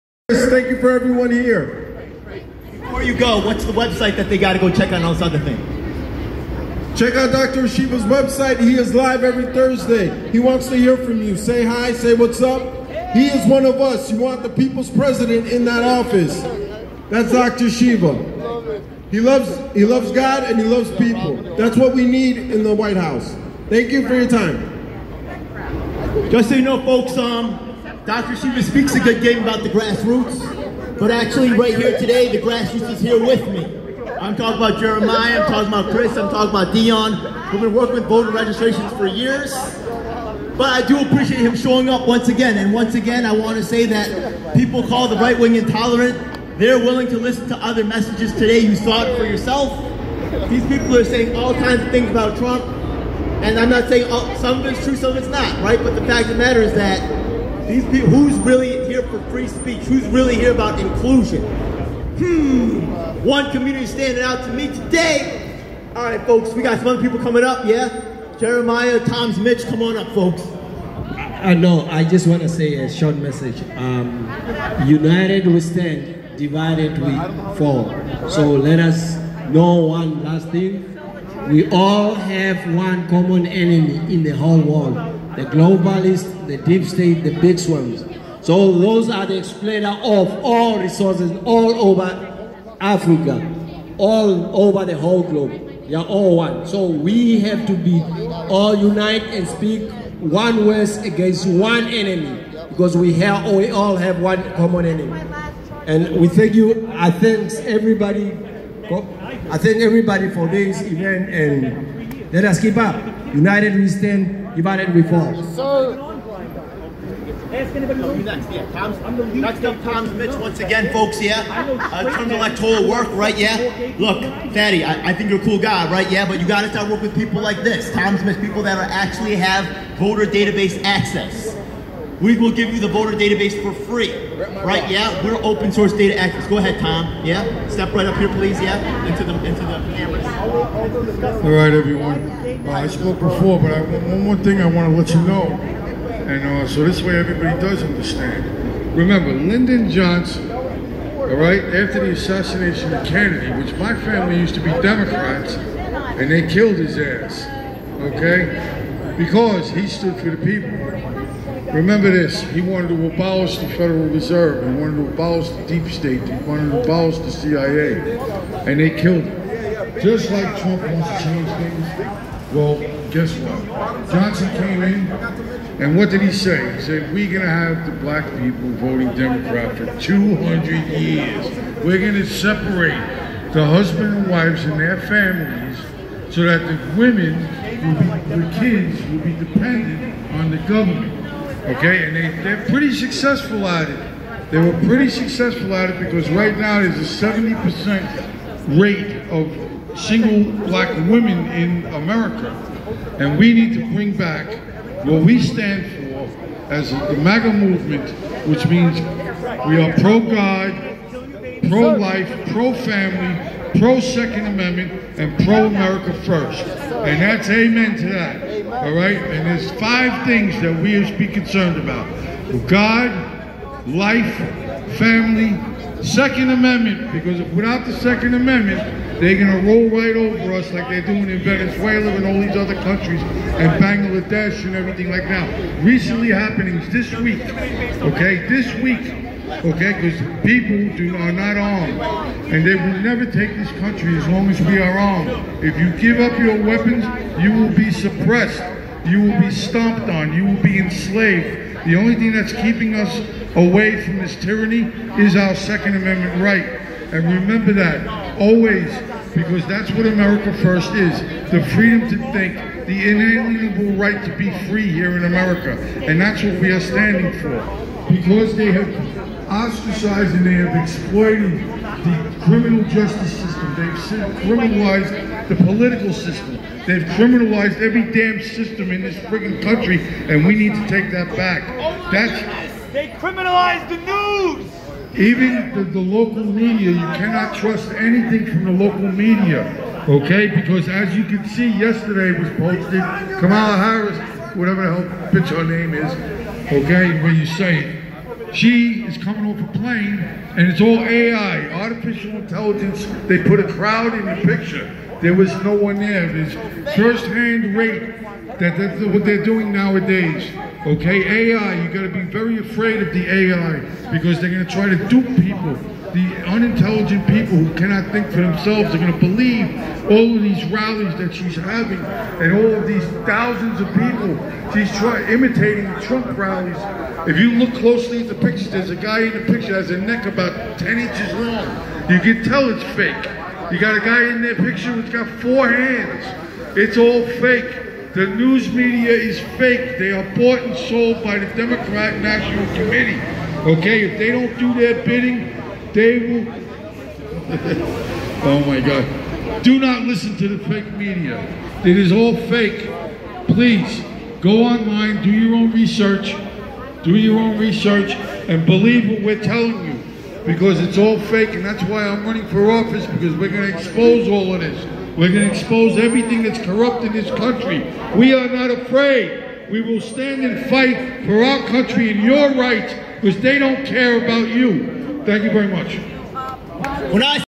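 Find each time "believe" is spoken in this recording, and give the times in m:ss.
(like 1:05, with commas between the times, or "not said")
5:19, 5:58.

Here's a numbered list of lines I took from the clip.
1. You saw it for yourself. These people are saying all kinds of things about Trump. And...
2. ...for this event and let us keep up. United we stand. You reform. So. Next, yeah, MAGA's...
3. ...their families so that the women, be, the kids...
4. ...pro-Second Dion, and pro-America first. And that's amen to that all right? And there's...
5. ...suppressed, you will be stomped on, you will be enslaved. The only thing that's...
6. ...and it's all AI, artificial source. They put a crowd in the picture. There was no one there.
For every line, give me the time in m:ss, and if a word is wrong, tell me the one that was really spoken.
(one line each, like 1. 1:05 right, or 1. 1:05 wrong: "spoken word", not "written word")
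1. 0:48 right
2. 1:50 wrong: "Tom", not "MAGA"
3. 3:04 right
4. 3:33 wrong: "Amendment", not "Dion"
5. 4:07 right
6. 5:00 wrong: "intelligence", not "source".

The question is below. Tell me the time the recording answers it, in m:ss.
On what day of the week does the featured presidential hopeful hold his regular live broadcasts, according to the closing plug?
0:09.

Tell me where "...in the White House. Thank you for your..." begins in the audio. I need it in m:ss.
0:22.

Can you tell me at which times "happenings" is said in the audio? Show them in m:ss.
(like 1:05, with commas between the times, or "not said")
3:56.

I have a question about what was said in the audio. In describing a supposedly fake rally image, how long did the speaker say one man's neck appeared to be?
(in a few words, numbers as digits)
10 inches.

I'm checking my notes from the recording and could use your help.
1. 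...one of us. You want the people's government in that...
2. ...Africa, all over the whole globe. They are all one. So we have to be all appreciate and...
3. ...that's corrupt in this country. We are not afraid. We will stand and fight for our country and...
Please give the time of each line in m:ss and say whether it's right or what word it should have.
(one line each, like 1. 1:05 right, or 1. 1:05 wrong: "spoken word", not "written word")
1. 0:13 wrong: "president", not "government"
2. 1:32 wrong: "unite", not "appreciate"
3. 6:06 right.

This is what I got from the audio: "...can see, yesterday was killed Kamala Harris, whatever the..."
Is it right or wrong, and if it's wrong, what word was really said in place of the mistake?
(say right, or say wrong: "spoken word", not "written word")
wrong: "posted", not "killed".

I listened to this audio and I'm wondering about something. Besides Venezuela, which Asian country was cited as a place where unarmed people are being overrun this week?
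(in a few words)
Bangladesh.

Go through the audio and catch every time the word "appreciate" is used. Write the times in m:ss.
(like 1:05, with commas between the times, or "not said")
0:41.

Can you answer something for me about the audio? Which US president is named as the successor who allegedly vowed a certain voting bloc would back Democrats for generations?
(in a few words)
Lyndon Johnson.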